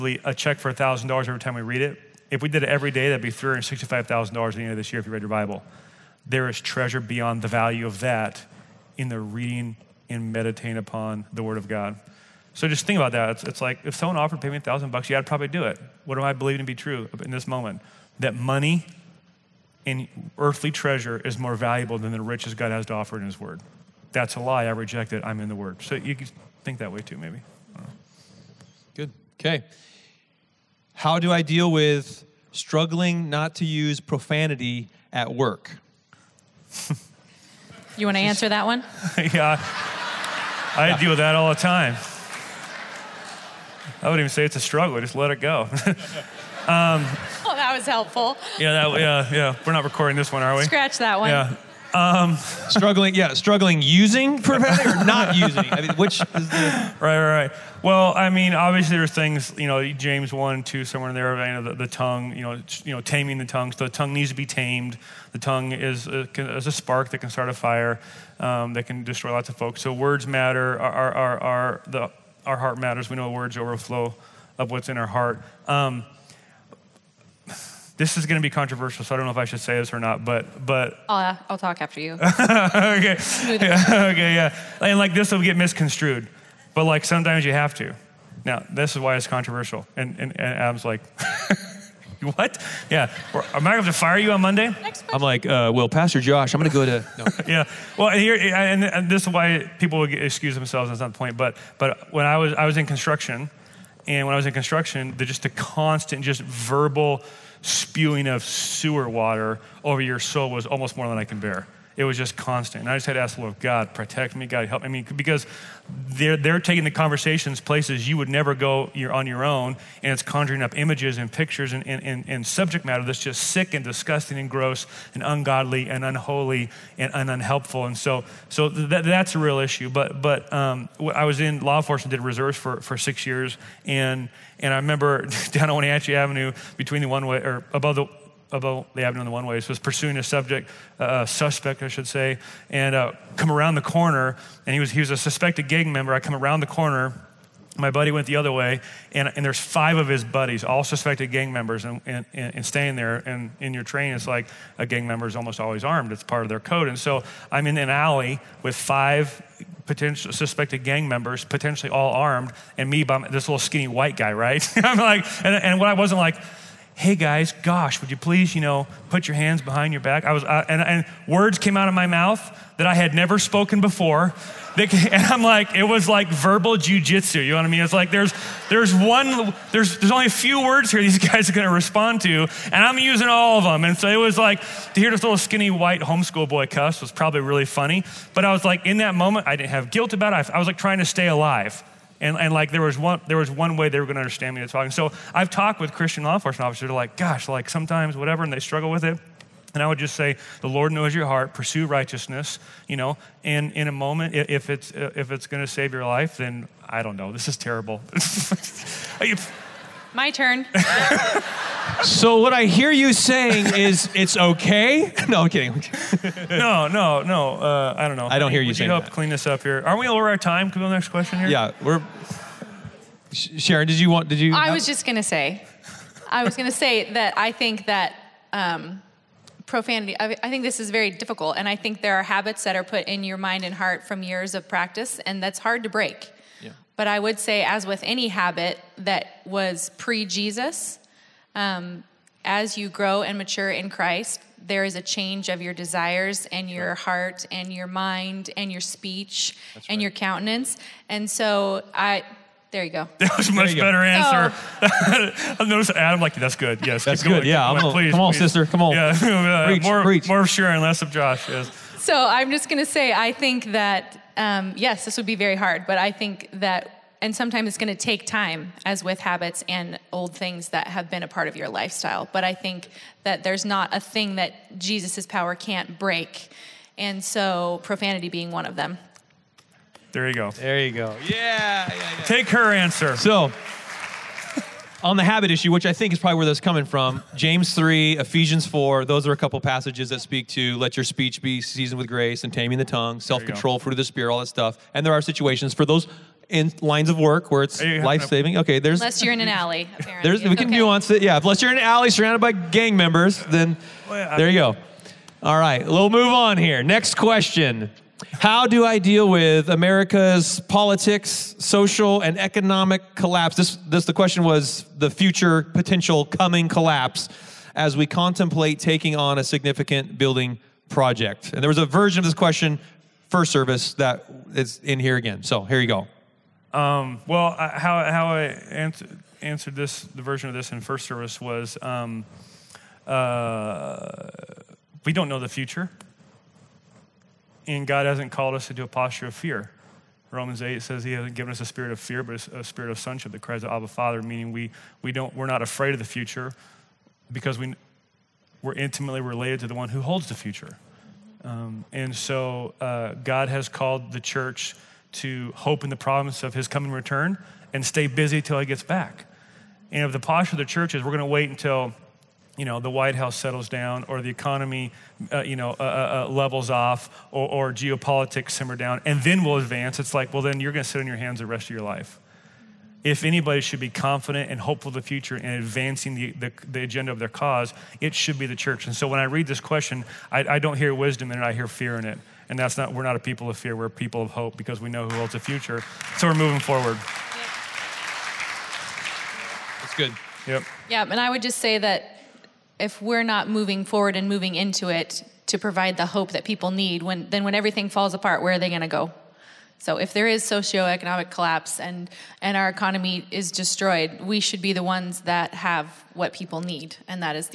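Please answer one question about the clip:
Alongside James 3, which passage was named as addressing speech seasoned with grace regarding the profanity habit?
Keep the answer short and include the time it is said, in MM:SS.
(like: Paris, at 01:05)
Ephesians 4, at 04:48.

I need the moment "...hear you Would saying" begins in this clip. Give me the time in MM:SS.
03:38.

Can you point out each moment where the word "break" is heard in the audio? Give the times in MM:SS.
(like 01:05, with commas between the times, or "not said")
03:55, 04:35.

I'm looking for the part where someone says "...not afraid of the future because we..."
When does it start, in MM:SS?
05:45.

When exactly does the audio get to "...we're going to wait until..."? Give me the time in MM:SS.
06:01.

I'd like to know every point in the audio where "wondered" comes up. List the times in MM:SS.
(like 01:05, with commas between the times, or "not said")
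not said.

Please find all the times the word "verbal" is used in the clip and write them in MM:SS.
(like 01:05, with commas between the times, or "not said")
01:46, 02:56.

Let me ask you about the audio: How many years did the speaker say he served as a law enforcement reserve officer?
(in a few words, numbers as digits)
6.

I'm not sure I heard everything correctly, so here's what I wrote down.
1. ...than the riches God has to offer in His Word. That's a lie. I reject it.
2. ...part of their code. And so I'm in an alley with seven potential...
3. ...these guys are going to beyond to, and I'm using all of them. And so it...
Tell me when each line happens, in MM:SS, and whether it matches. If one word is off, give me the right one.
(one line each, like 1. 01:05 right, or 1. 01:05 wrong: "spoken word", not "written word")
1. 00:21 right
2. 02:36 wrong: "five", not "seven"
3. 03:01 wrong: "respond", not "beyond".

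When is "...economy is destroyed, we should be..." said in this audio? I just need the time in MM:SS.
06:42.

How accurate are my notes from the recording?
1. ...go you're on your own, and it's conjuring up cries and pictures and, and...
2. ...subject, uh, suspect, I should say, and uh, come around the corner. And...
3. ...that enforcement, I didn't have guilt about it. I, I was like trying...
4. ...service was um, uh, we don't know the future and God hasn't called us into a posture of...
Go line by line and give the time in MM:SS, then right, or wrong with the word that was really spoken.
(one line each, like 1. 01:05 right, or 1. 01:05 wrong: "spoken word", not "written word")
1. 01:58 wrong: "images", not "cries"
2. 02:20 right
3. 03:08 wrong: "moment", not "enforcement"
4. 05:31 right.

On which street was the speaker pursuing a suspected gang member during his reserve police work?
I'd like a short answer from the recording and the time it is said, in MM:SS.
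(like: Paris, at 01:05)
Wenatchee Avenue, at 02:15.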